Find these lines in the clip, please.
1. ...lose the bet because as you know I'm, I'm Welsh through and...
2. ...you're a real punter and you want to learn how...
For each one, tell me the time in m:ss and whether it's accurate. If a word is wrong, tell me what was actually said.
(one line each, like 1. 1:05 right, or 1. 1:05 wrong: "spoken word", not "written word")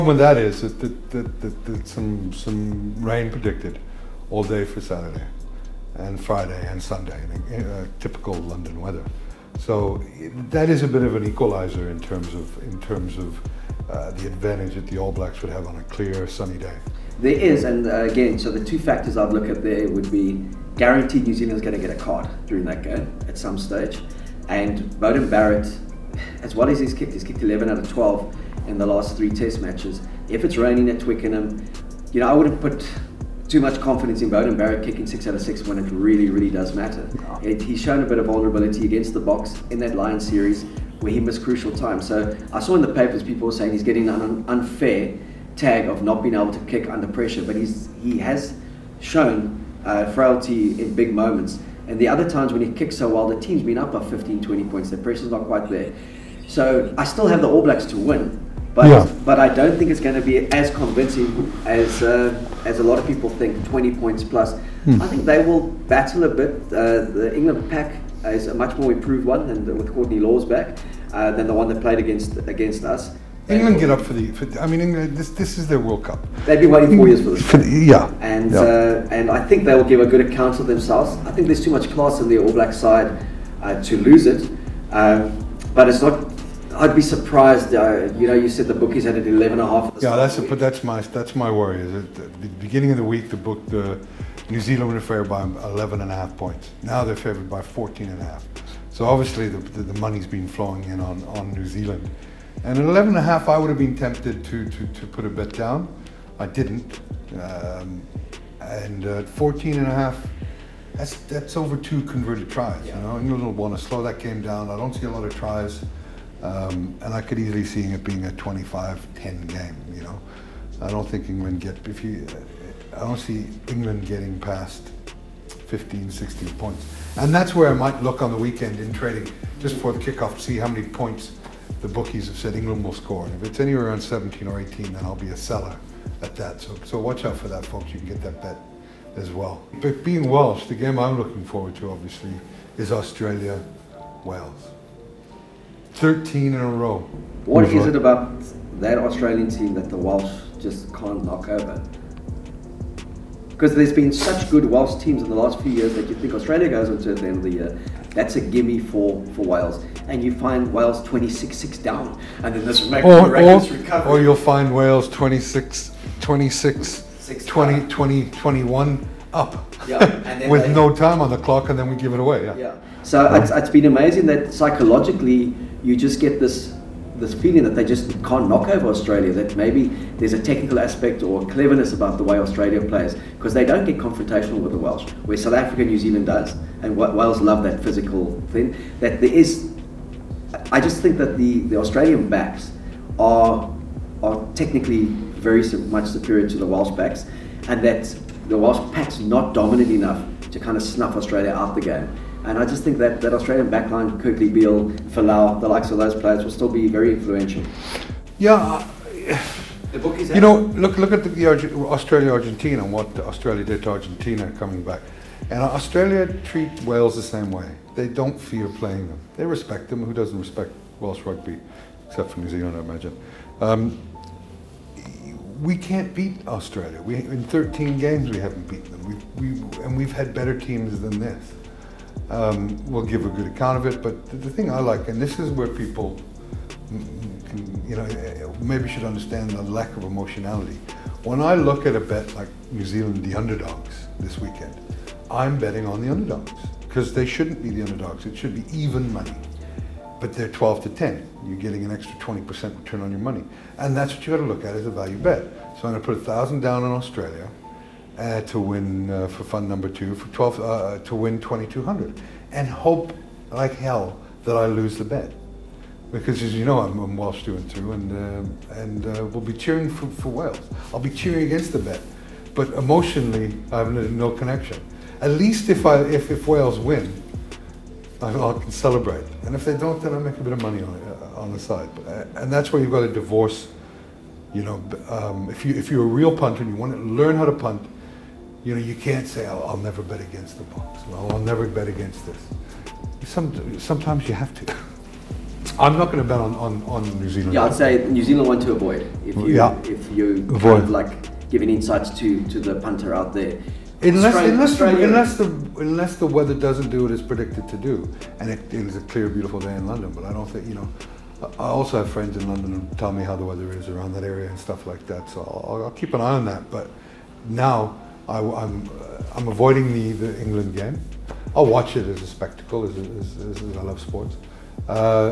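1. 4:24 right
2. 4:45 right.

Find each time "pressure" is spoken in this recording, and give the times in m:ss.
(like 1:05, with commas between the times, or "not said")
0:47, 0:54.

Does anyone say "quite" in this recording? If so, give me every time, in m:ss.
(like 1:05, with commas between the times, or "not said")
0:55.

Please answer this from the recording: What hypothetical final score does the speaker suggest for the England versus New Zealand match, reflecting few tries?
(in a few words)
25-10.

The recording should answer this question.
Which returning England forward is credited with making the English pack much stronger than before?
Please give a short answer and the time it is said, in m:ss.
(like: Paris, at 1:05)
Courtney Lawes, at 1:09.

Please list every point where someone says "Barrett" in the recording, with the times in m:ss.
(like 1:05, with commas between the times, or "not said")
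0:25, 0:34.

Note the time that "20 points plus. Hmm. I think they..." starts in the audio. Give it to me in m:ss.
1:03.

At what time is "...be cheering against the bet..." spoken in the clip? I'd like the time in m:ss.
4:31.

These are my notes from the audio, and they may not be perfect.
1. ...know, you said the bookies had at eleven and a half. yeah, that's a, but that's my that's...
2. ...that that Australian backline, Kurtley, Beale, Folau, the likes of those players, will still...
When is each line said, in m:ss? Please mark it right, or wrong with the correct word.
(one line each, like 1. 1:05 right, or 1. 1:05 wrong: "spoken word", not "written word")
1. 1:28 right
2. 3:22 right.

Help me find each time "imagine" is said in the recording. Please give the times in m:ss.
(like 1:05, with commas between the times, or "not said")
3:42.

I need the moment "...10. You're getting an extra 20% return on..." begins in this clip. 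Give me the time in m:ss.
4:10.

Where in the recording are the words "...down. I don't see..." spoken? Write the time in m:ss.
1:54.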